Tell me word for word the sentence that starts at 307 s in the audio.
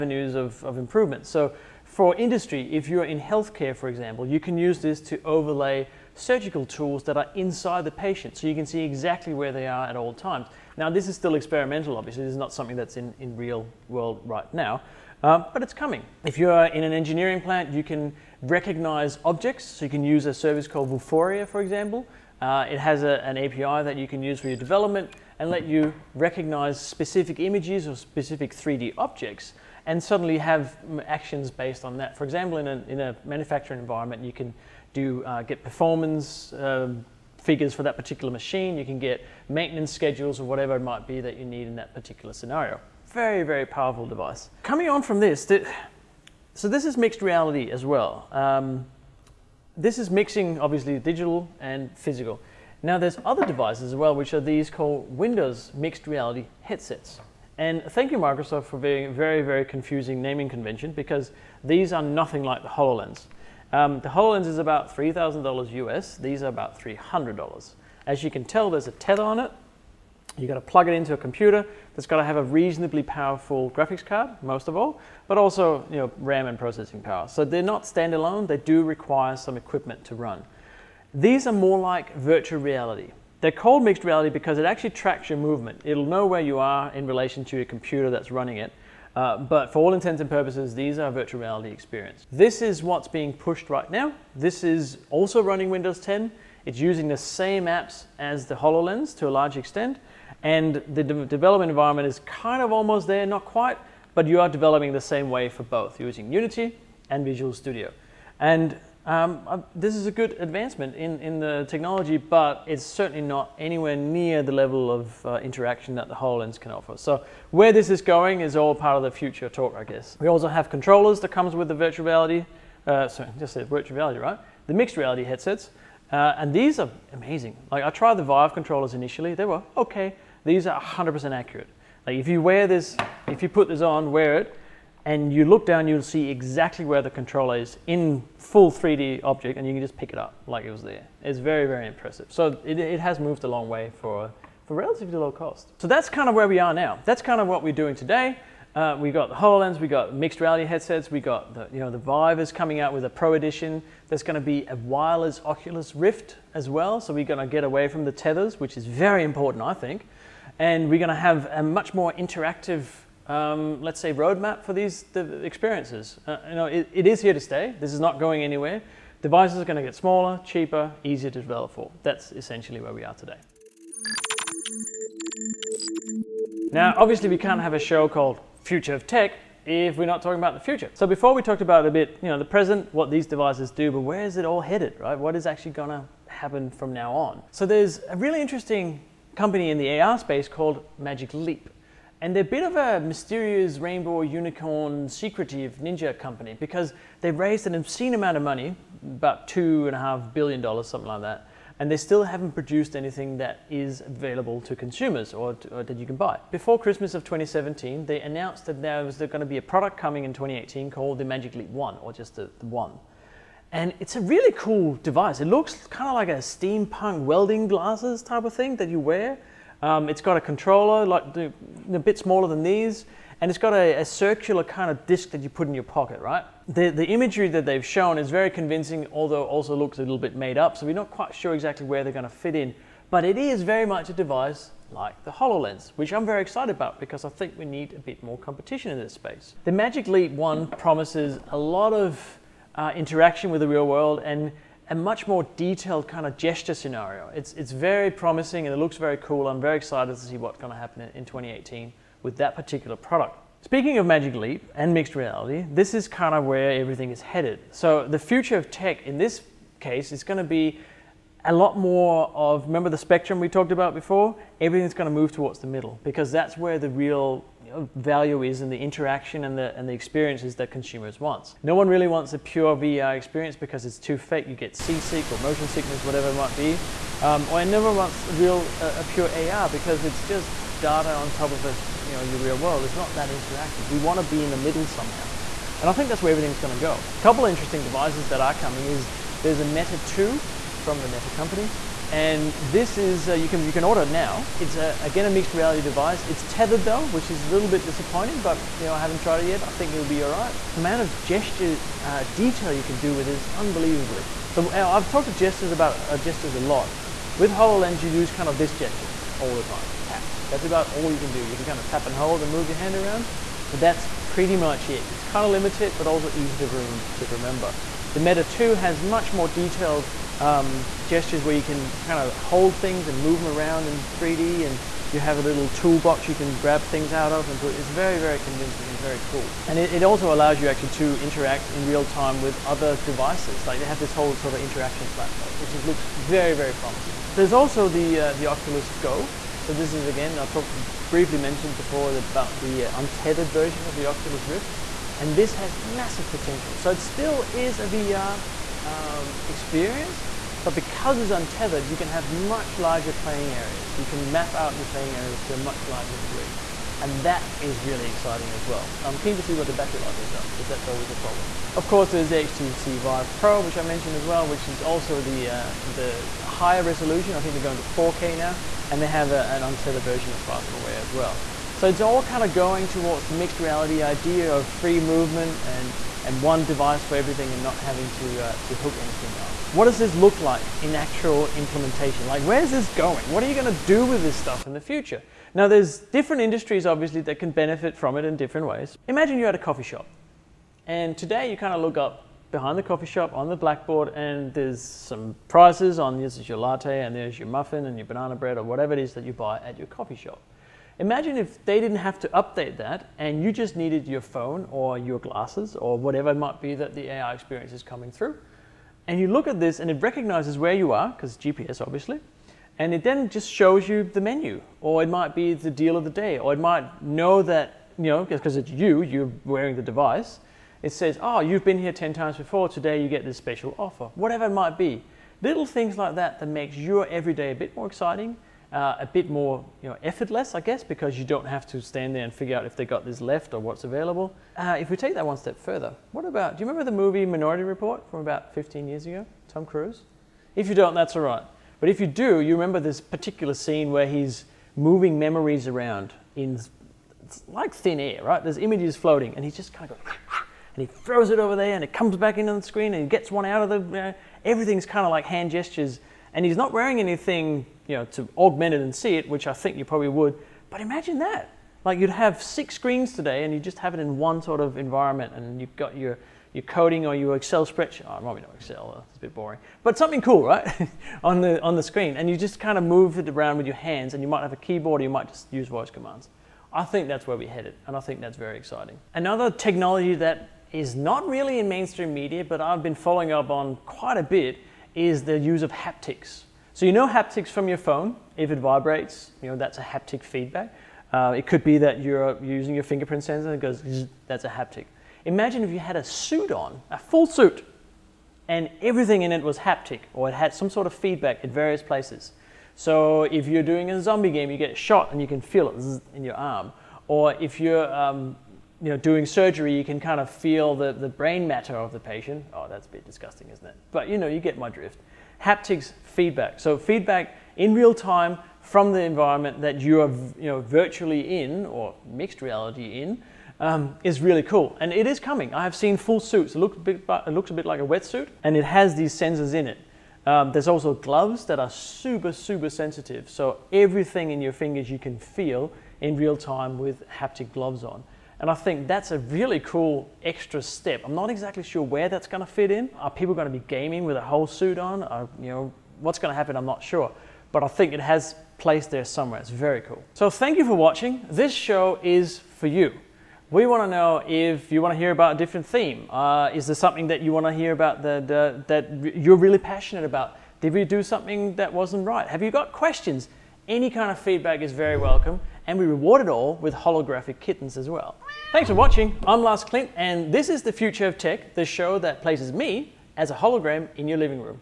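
With HoloLens, you use kind of this gesture all the time, tap.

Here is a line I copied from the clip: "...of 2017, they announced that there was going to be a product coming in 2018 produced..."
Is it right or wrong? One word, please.
wrong.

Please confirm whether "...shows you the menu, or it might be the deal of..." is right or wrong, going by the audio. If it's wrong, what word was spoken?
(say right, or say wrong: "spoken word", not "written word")
right.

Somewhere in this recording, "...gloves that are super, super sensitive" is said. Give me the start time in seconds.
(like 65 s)
530 s.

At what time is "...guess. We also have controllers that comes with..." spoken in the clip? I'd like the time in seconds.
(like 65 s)
119 s.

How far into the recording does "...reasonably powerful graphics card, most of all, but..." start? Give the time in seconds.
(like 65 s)
72 s.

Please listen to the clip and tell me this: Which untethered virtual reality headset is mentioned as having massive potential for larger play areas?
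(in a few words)
Oculus Go.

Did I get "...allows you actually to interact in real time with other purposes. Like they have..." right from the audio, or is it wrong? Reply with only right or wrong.
wrong.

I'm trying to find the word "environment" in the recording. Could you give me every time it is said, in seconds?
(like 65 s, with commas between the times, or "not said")
33 s, 101 s, 464 s, 519 s.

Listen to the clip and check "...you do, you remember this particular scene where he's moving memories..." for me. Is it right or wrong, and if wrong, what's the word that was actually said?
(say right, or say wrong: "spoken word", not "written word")
right.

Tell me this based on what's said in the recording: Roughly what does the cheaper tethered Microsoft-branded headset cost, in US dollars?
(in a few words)
$300.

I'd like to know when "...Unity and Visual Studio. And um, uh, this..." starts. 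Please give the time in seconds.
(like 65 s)
106 s.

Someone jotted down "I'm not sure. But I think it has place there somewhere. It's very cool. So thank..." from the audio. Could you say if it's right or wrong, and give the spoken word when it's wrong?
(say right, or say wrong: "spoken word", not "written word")
right.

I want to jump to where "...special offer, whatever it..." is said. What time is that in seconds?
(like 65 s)
423 s.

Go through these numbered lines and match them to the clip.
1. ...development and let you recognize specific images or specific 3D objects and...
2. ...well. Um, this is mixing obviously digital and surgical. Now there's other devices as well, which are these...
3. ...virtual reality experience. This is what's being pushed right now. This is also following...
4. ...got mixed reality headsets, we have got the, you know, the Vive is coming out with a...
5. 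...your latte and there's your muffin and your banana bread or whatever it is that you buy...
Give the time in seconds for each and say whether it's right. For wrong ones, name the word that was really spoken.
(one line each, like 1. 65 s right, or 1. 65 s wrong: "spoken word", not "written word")
1. 24 s right
2. 47 s wrong: "physical", not "surgical"
3. 91 s wrong: "running", not "following"
4. 149 s right
5. 396 s right.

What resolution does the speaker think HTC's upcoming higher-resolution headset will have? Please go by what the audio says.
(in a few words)
4K.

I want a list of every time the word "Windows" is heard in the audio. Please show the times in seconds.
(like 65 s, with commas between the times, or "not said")
55 s, 95 s.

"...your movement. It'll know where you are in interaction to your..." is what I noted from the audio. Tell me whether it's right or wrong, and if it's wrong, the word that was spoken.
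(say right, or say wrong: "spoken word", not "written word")
wrong: "relation", not "interaction".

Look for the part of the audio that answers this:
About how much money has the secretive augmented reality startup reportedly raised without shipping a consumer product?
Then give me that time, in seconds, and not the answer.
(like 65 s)
199 s.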